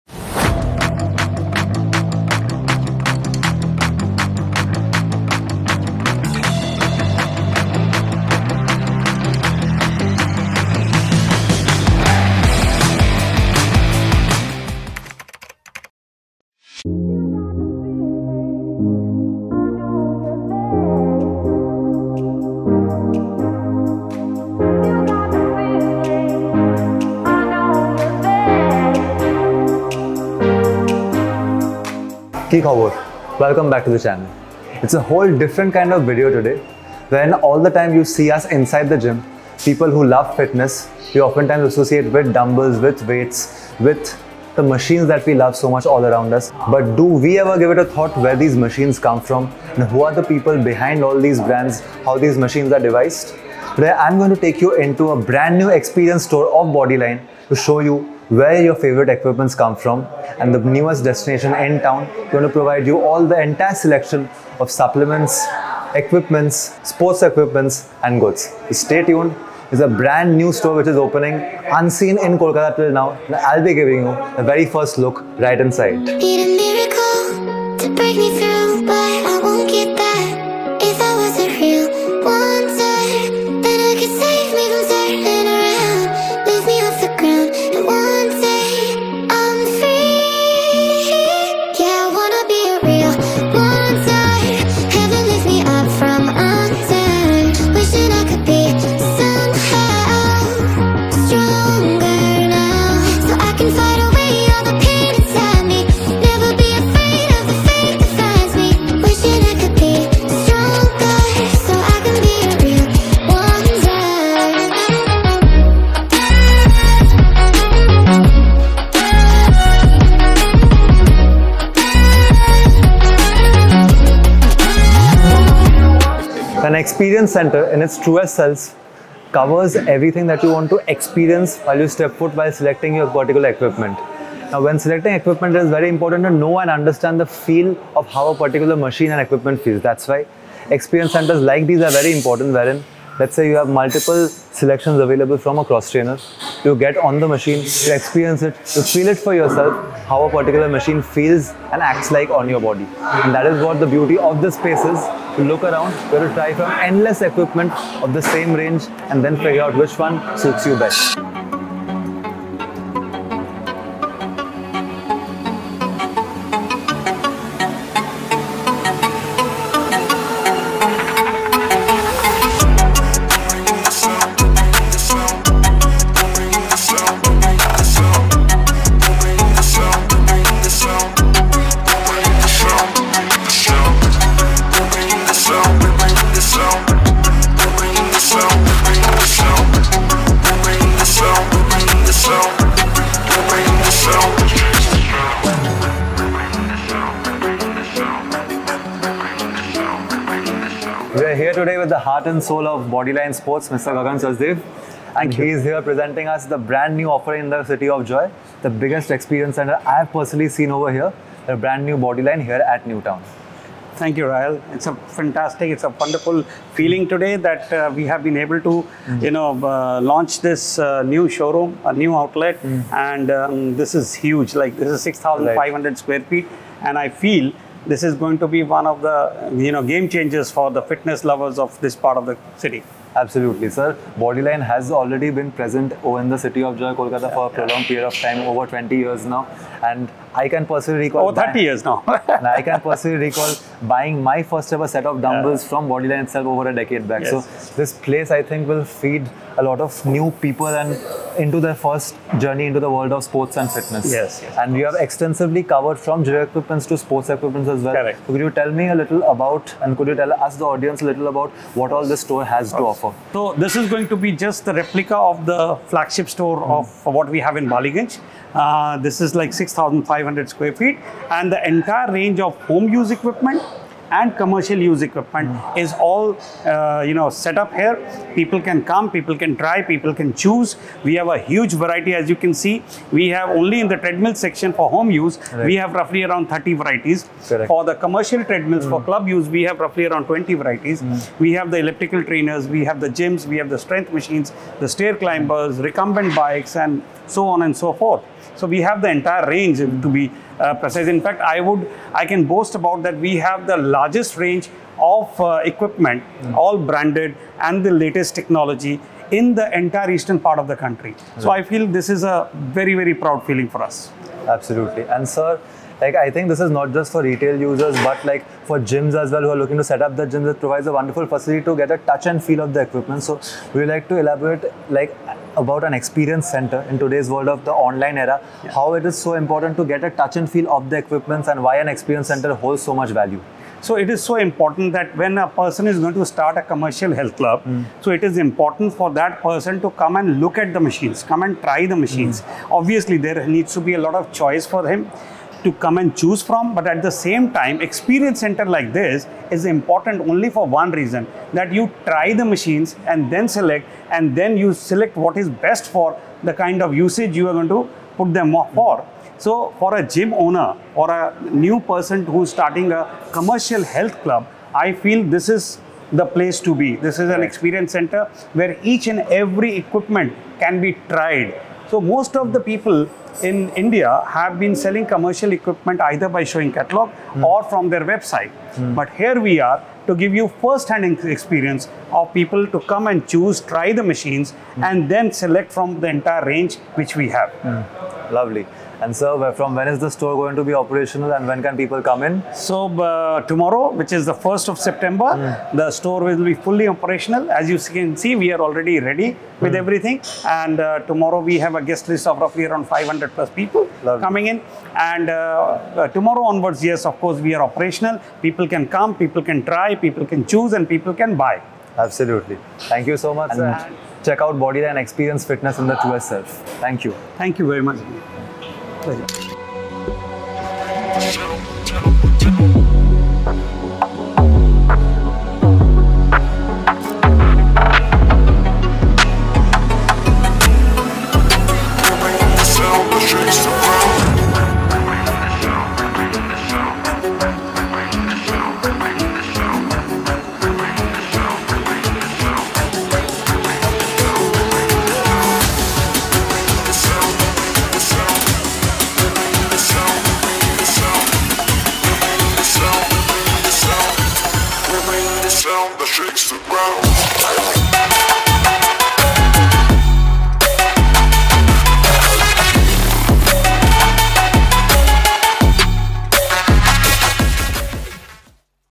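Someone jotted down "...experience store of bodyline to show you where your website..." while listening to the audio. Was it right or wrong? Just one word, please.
wrong.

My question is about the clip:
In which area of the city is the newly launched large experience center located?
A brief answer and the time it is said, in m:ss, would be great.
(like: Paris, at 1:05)
Newtown, at 3:32.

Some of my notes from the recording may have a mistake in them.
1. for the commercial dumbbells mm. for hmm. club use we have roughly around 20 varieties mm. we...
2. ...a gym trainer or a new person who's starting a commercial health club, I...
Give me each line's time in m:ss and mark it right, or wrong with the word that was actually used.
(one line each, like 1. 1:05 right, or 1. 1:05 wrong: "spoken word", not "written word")
1. 4:47 wrong: "treadmills", not "dumbbells"
2. 5:59 wrong: "owner", not "trainer".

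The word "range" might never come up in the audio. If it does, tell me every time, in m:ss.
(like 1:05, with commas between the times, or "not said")
2:38, 4:32, 4:59, 5:04, 6:26.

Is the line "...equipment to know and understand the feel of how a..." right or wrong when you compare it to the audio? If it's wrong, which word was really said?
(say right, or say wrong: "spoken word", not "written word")
wrong: "important", not "equipment".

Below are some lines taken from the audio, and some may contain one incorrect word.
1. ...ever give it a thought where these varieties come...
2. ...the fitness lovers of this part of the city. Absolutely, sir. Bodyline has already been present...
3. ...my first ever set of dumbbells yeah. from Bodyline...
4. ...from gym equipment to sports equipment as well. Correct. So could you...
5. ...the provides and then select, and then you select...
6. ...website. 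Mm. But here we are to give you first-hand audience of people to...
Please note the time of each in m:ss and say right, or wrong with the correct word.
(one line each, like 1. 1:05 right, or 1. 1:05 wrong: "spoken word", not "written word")
1. 0:47 wrong: "machines", not "varieties"
2. 3:50 right
3. 4:04 right
4. 4:15 right
5. 5:52 wrong: "machines", not "provides"
6. 6:18 wrong: "experience", not "audience".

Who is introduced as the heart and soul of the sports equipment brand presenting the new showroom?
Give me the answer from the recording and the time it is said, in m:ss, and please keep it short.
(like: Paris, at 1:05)
Gagan Sachdev, at 3:23.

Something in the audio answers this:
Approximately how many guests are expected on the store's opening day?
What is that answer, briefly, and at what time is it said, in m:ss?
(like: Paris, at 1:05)
500 plus, at 6:42.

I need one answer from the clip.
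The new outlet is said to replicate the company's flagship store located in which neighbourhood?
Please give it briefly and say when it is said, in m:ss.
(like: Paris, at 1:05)
Ballygunge, at 4:27.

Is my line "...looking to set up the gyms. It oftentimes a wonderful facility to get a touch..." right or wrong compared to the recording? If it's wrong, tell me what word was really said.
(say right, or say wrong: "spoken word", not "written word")
wrong: "provides", not "oftentimes".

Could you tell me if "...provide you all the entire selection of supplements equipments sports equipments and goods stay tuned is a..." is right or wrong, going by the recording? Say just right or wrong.
right.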